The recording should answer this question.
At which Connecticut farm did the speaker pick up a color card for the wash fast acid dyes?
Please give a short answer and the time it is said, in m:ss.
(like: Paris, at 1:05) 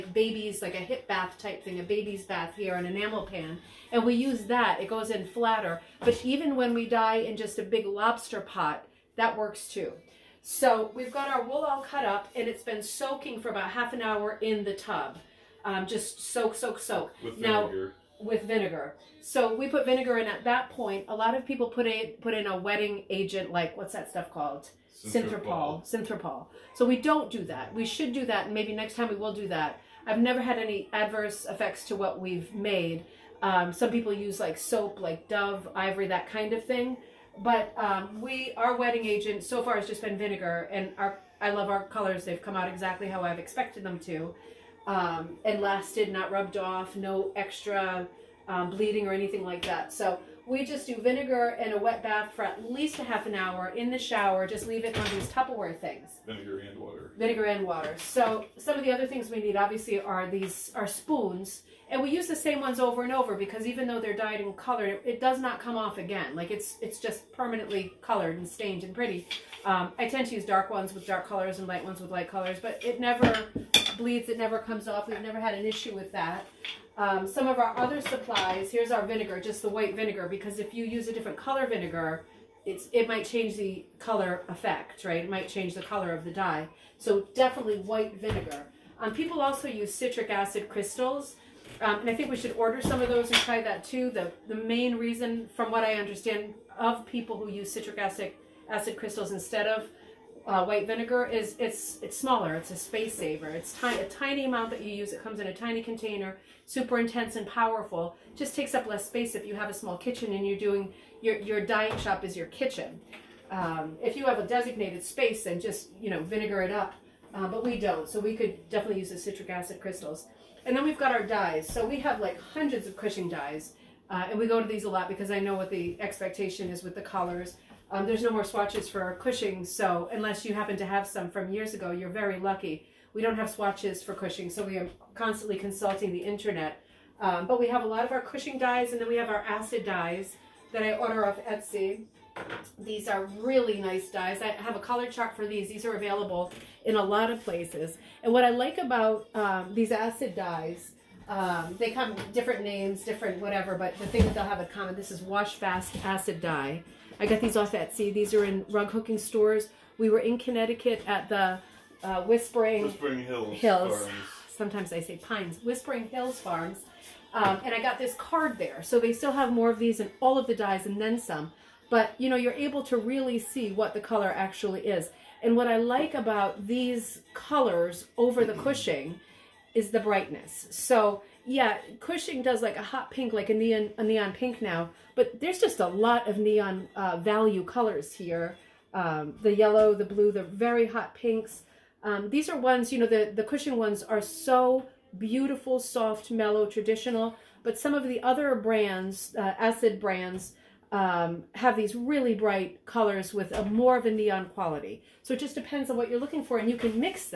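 Whispering Hills Farms, at 2:45.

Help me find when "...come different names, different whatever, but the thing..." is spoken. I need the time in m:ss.
2:31.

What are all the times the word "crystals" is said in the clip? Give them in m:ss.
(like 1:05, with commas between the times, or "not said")
1:30, 1:38, 1:59.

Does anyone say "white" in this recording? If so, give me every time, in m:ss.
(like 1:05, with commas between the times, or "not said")
1:19, 1:27, 1:40.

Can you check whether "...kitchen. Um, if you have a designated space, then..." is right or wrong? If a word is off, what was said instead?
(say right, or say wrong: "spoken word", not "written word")
right.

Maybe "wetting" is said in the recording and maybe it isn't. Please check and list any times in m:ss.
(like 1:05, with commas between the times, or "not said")
0:22, 0:38.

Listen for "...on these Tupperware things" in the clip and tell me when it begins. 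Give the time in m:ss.
0:54.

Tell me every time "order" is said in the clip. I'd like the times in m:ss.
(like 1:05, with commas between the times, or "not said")
1:32, 2:20.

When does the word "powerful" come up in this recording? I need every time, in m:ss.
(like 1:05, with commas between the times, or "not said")
1:47.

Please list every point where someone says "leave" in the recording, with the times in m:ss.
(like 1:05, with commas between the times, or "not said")
0:54.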